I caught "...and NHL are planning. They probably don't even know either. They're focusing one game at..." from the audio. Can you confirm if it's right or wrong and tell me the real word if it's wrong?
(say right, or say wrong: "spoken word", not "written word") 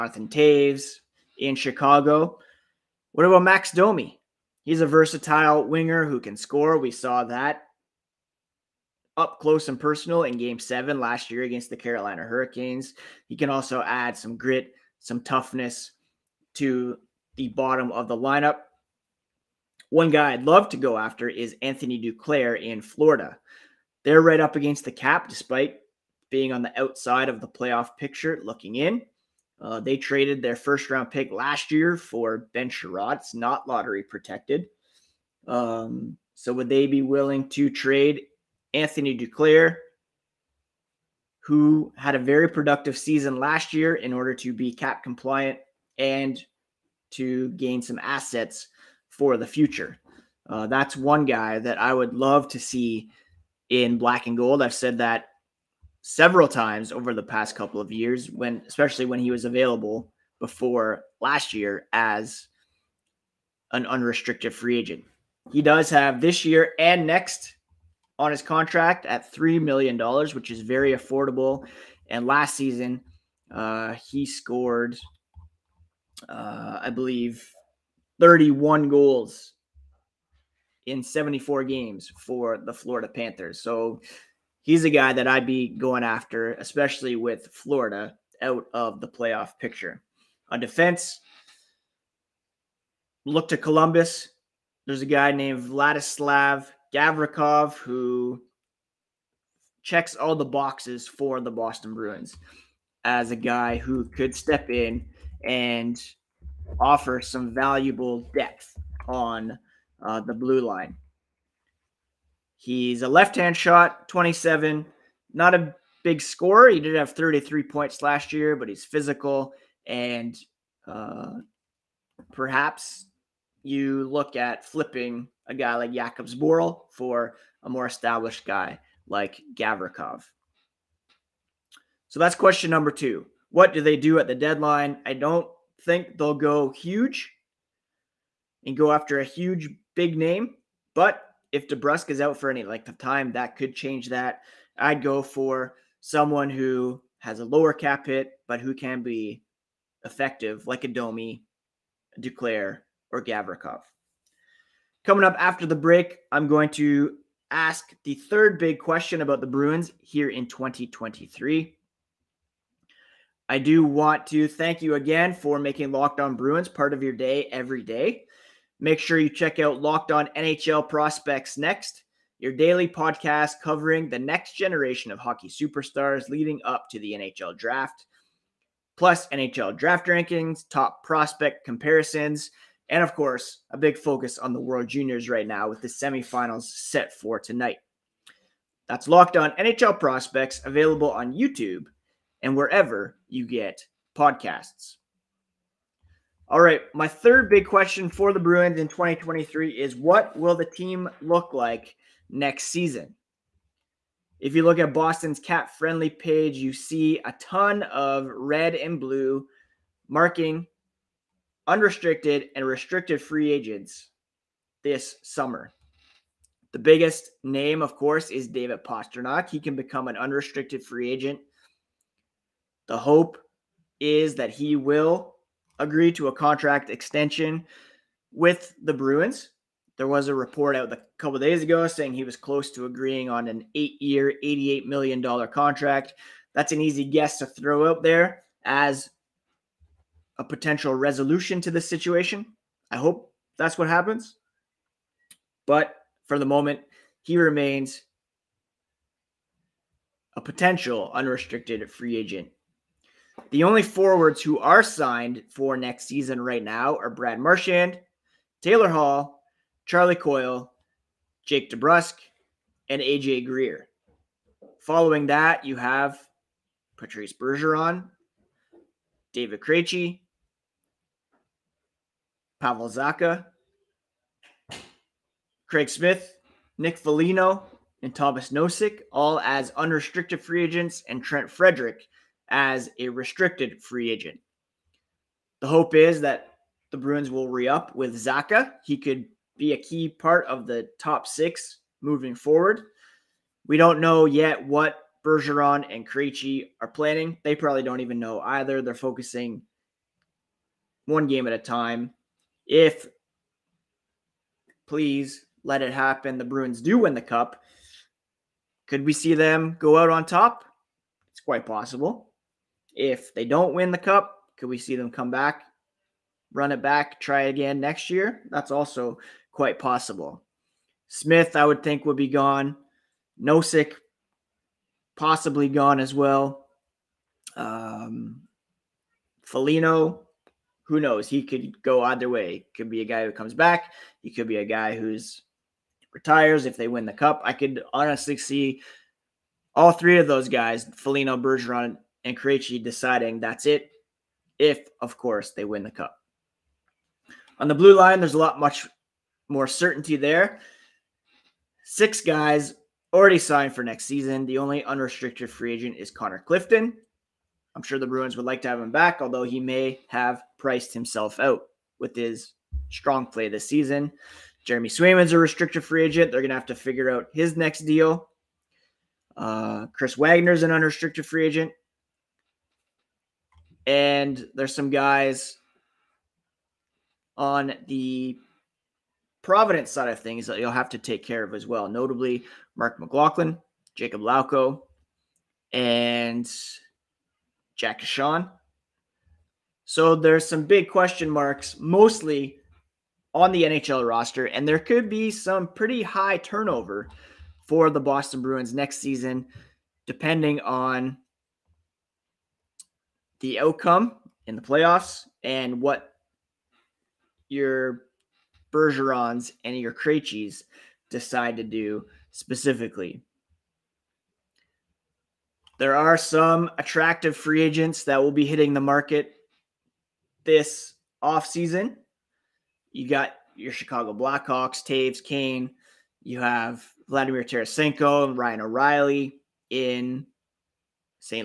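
wrong: "Krejci", not "NHL".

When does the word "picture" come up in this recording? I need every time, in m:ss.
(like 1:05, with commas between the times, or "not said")
0:27, 1:29.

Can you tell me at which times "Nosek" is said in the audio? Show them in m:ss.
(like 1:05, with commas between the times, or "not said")
4:38, 5:23.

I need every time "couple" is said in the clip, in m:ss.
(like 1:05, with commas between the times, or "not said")
0:57, 3:51.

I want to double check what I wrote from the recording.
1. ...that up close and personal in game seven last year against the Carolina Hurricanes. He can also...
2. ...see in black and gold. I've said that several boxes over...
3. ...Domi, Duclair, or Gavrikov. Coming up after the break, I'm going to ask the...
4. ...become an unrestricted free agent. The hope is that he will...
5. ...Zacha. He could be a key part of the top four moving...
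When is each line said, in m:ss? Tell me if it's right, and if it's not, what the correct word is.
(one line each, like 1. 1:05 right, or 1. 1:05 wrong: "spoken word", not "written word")
1. 0:07 right
2. 0:52 wrong: "times", not "boxes"
3. 2:30 right
4. 3:39 right
5. 4:48 wrong: "six", not "four".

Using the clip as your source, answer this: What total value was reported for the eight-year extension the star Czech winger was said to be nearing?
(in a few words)
$88 million.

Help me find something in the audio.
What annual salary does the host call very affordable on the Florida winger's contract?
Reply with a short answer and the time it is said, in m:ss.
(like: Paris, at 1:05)
$3 million, at 1:09.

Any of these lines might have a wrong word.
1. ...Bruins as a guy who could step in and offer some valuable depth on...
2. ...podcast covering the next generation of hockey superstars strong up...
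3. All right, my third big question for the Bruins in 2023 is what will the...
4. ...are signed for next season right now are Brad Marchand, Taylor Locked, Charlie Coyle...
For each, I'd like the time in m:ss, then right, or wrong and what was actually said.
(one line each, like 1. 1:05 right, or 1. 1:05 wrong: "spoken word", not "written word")
1. 1:41 right
2. 2:52 wrong: "leading", not "strong"
3. 3:16 right
4. 4:14 wrong: "Hall", not "Locked".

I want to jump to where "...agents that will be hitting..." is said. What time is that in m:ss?
6:57.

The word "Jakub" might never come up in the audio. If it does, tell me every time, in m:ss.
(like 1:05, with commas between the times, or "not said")
2:05, 6:23.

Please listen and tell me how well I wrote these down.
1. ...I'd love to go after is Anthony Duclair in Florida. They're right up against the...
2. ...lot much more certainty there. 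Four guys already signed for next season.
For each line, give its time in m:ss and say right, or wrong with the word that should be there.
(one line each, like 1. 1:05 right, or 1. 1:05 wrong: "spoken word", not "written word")
1. 0:20 right
2. 5:48 wrong: "Six", not "Four".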